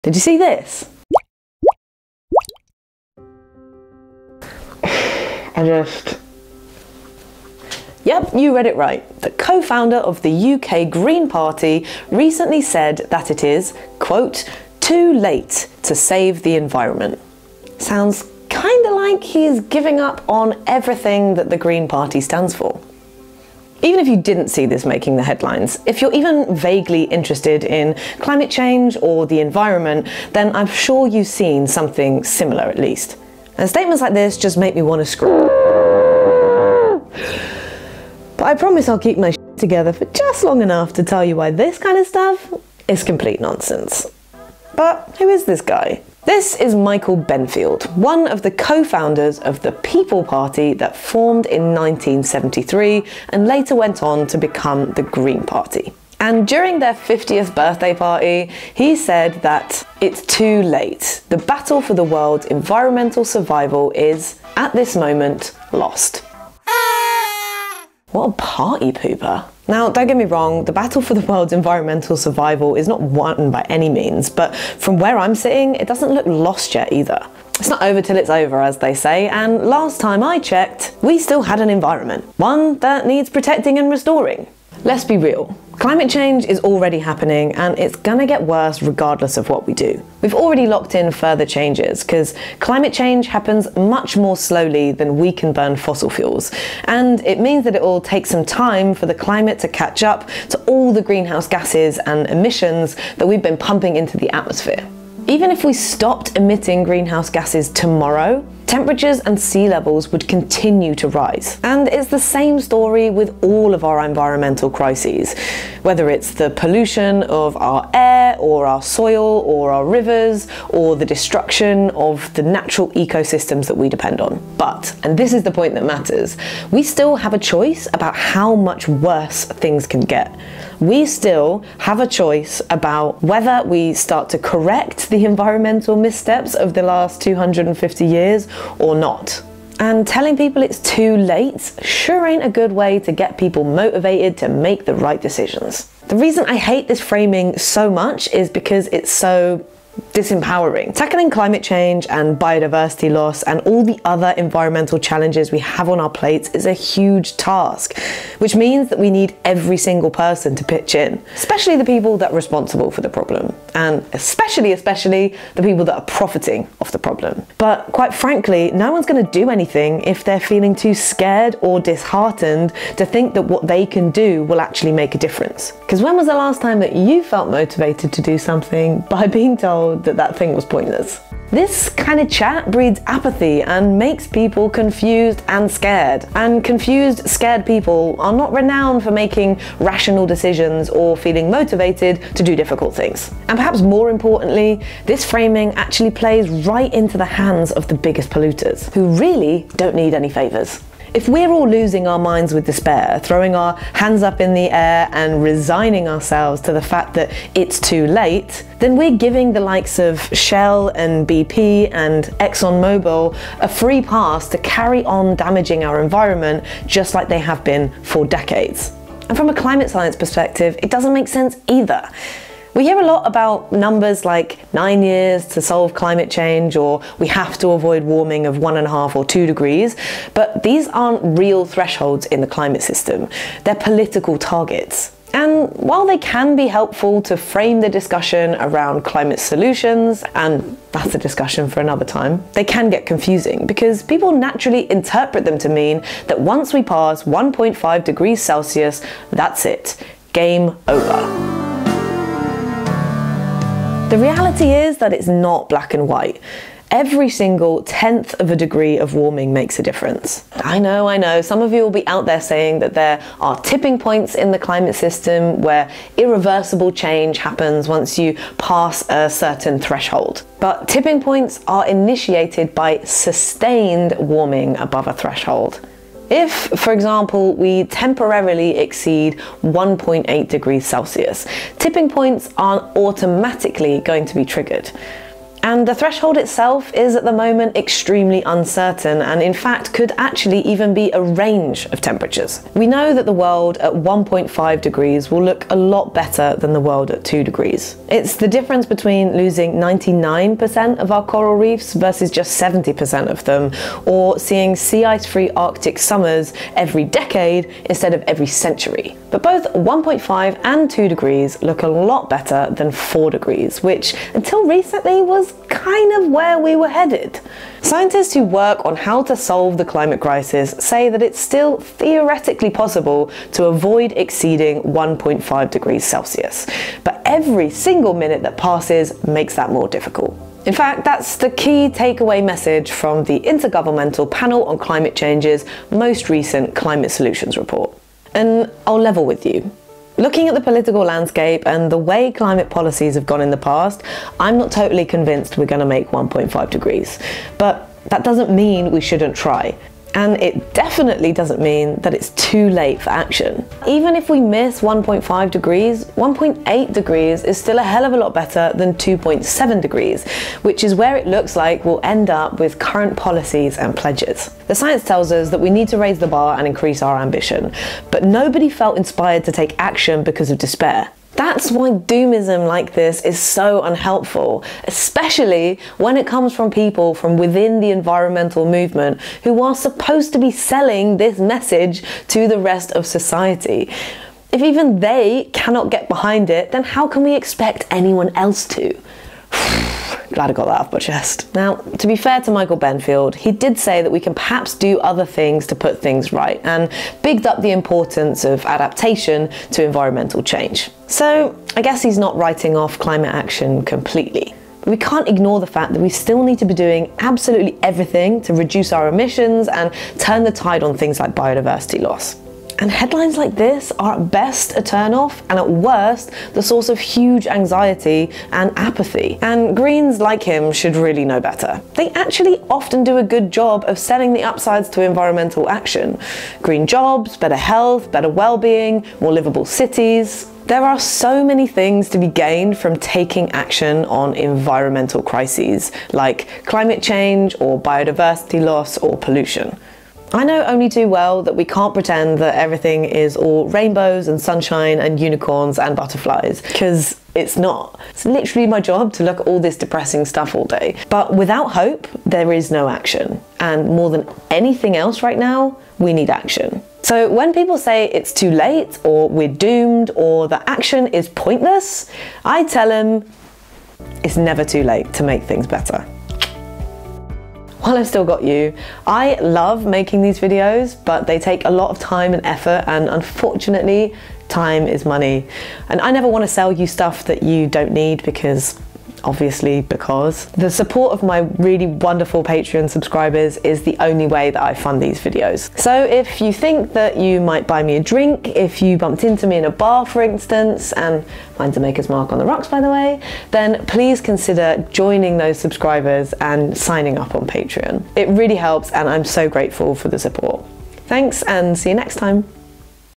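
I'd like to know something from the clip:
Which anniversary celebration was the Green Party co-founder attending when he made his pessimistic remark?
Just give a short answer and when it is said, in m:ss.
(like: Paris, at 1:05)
50th birthday, at 0:56.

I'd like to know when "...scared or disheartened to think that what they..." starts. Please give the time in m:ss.
2:50.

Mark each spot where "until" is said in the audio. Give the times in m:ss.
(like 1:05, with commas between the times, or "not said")
5:14.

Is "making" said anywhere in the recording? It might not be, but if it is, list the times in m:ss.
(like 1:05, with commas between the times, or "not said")
0:24, 3:09, 7:49.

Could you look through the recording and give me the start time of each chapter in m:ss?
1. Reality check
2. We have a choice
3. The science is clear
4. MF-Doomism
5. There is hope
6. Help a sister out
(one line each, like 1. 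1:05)
1. 1:24
2. 2:04
3. 3:39
4. 6:12
5. 7:12
6. 7:47.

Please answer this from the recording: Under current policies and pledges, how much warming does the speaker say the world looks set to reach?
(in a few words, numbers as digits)
2.7 degrees.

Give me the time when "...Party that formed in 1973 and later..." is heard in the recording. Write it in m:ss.
0:50.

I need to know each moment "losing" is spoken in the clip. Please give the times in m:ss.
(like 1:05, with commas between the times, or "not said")
3:21, 4:59.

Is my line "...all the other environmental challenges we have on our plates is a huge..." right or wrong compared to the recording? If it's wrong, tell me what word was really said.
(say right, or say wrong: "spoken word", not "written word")
right.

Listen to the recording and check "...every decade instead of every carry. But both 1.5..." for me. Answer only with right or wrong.
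wrong.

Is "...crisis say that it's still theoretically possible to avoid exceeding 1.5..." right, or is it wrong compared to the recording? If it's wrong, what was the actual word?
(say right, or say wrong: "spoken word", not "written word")
right.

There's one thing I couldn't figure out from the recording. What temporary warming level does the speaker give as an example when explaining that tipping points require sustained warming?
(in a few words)
1.8 degrees Celsius.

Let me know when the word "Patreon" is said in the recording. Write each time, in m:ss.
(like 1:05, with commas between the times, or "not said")
8:02, 8:17.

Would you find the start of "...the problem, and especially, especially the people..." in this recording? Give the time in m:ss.
2:43.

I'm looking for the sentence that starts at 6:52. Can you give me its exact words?
And headlines like this are at best a turnoff and at worst the source of huge anxiety and apathy.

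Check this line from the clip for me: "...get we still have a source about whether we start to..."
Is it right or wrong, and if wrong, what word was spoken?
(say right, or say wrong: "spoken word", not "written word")
wrong: "choice", not "source".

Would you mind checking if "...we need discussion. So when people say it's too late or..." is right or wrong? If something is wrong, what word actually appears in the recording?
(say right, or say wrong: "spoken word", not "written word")
wrong: "action", not "discussion".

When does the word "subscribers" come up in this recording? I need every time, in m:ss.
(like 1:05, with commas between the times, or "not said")
8:02, 8:15.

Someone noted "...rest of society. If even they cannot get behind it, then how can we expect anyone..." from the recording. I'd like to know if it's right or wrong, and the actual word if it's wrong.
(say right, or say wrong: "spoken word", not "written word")
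right.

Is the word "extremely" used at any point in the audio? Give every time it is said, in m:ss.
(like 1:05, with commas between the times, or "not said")
4:47.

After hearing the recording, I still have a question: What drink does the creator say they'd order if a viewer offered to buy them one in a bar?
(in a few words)
Maker's Mark on the rocks.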